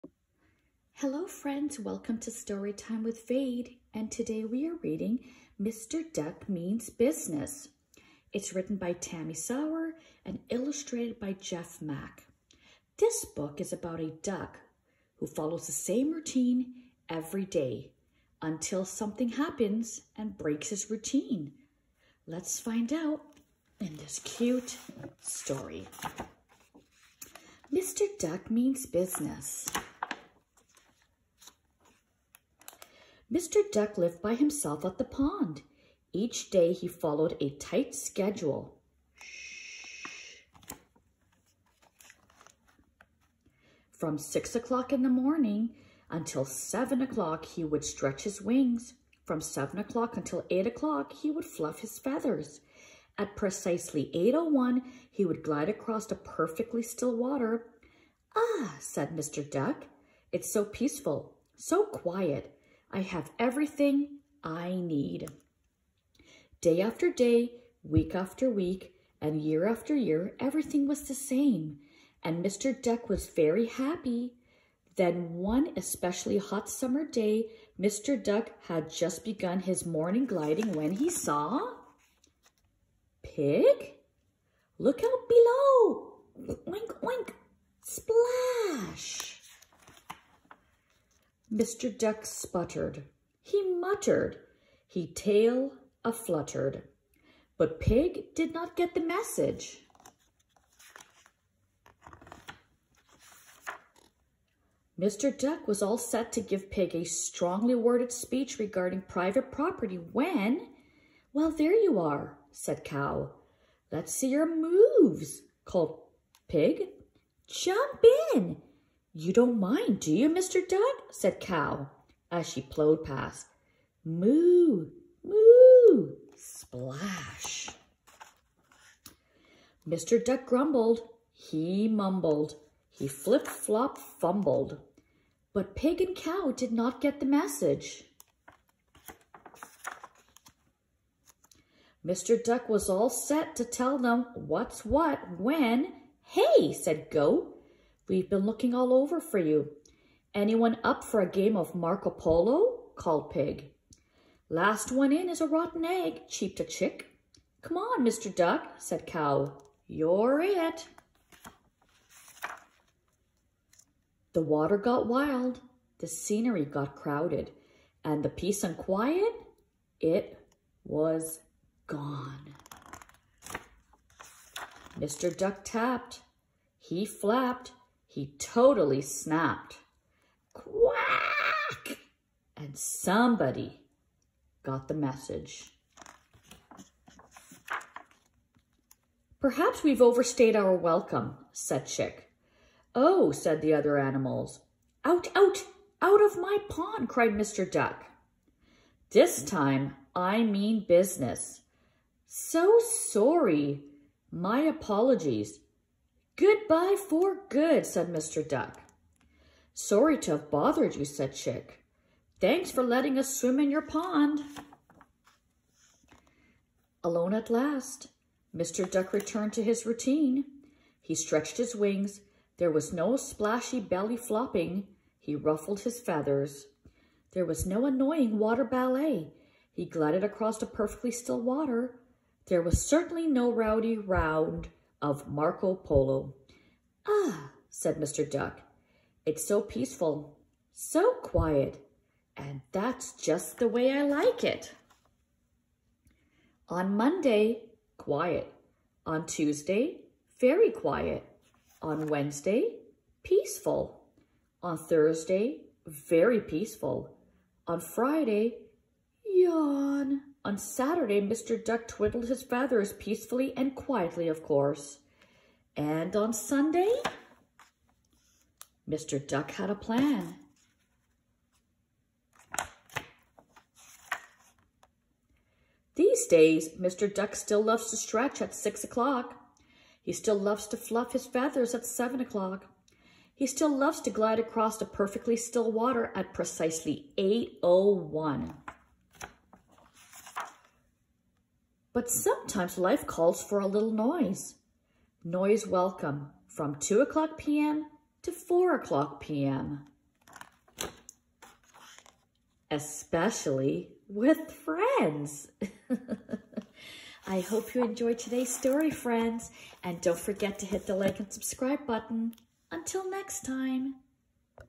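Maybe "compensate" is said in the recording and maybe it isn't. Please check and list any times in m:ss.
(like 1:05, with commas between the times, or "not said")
not said.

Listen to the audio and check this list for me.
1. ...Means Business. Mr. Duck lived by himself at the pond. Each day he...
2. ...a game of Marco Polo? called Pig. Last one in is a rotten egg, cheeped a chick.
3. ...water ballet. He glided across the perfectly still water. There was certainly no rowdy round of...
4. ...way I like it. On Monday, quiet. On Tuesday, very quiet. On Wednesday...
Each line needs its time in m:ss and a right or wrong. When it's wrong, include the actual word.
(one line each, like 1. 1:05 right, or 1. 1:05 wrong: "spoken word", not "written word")
1. 0:28 right
2. 2:31 right
3. 3:48 right
4. 4:03 right.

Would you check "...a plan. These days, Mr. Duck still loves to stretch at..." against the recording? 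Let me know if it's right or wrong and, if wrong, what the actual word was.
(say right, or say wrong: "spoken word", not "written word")
right.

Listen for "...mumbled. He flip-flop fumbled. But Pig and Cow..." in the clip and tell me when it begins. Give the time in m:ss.
2:11.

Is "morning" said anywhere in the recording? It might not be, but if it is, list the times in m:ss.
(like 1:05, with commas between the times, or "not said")
0:45, 1:19.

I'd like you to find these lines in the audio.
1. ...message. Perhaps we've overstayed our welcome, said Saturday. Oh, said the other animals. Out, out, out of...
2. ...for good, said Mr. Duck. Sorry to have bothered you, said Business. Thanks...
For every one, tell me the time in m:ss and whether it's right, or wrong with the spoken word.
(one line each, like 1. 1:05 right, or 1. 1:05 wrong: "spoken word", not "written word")
1. 3:04 wrong: "Chick", not "Saturday"
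2. 3:27 wrong: "Chick", not "Business".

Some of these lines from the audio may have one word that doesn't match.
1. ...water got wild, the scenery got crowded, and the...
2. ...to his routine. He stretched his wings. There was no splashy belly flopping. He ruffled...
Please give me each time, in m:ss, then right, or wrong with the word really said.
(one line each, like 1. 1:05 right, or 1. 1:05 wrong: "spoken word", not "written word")
1. 2:44 right
2. 3:39 right.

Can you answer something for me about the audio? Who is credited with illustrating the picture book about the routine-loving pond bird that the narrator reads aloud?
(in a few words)
Jeff Mack.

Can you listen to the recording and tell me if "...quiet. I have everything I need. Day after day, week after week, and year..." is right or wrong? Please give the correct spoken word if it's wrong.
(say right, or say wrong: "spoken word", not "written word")
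right.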